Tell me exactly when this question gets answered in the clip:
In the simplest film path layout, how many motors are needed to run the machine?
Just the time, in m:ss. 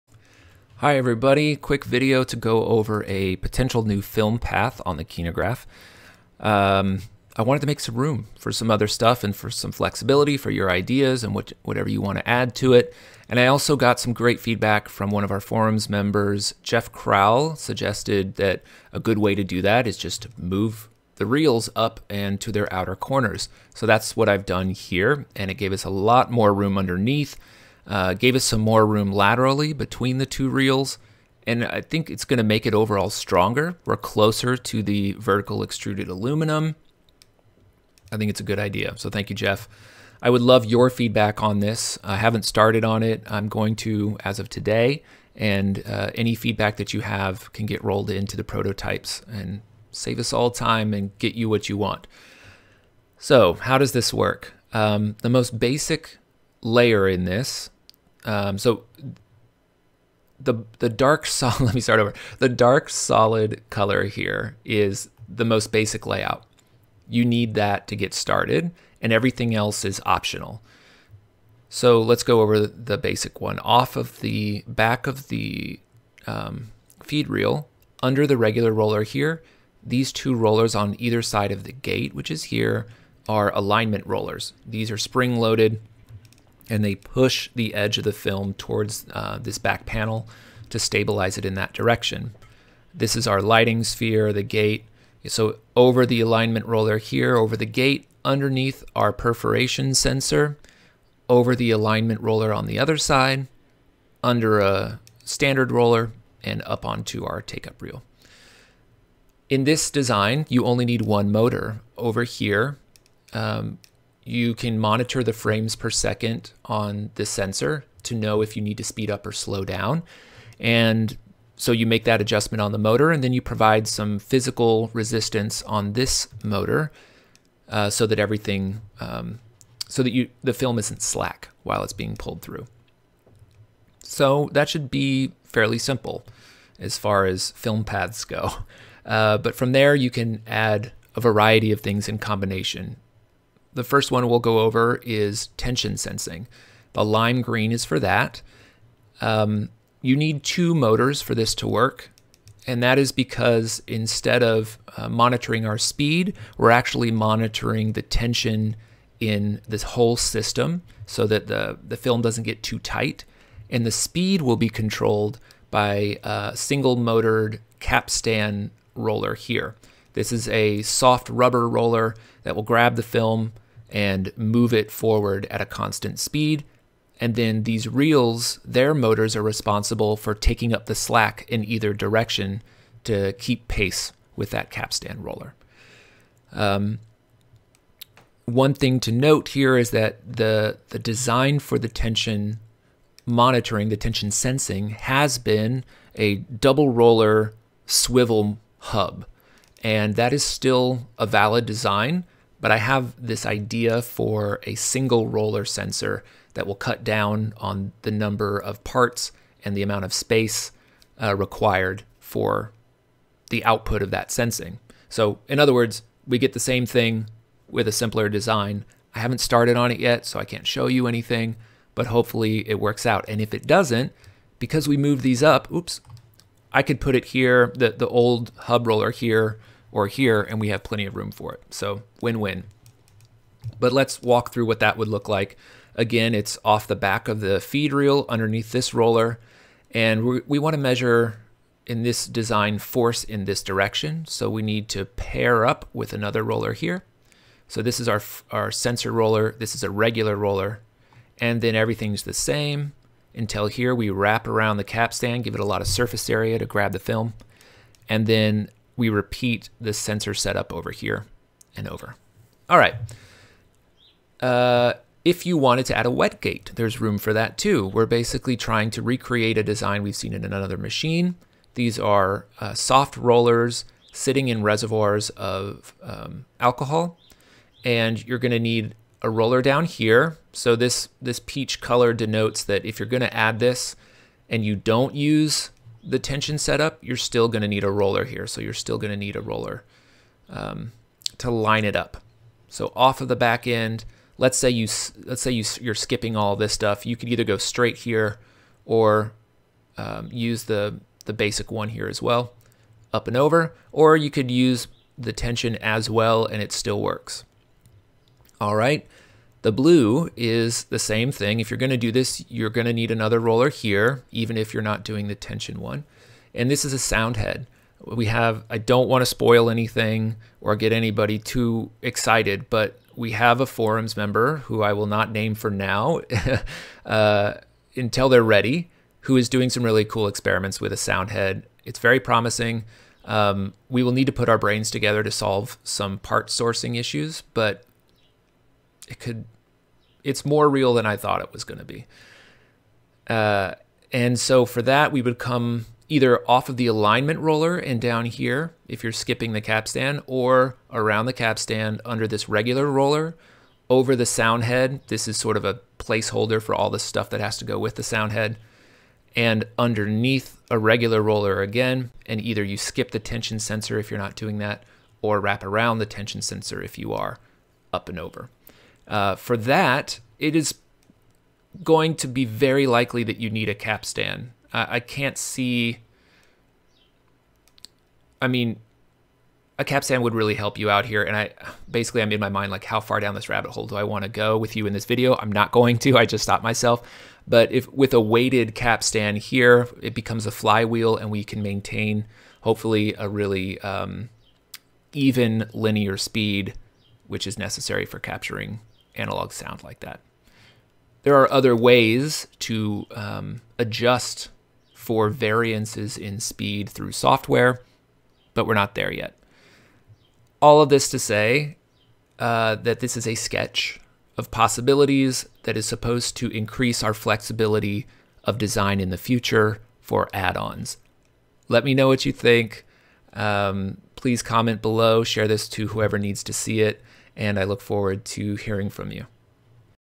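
1:51.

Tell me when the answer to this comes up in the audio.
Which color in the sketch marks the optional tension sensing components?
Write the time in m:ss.
2:27.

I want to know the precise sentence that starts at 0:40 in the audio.
I would love your feedback on this.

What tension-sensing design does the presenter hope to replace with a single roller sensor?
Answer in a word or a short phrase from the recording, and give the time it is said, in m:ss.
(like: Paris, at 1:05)
double roller swivel hub, at 3:16.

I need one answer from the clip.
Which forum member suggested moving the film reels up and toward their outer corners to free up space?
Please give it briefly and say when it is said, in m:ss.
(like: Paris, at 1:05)
Jeff Crowell, at 0:16.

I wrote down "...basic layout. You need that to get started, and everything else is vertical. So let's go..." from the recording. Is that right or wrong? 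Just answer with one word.
wrong.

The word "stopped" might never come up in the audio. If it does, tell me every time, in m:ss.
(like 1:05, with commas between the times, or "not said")
6:26.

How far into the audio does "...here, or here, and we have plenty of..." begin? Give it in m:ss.
3:49.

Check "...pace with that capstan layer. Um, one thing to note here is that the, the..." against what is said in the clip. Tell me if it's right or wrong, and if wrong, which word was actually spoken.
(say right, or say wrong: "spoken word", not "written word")
wrong: "roller", not "layer".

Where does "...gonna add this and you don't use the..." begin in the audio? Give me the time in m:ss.
4:43.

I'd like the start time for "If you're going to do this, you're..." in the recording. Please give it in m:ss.
5:11.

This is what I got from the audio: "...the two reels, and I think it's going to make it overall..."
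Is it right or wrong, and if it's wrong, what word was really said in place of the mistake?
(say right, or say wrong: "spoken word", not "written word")
right.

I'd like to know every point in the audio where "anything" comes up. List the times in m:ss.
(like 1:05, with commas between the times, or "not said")
3:41, 5:19.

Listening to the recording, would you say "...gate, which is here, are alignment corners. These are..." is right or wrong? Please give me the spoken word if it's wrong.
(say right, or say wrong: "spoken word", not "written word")
wrong: "rollers", not "corners".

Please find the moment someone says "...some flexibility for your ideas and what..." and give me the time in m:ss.
0:09.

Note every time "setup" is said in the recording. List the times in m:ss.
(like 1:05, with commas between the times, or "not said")
4:20, 4:46.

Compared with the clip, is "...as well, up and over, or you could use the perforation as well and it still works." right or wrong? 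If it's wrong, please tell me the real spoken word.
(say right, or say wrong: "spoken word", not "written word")
wrong: "tension", not "perforation".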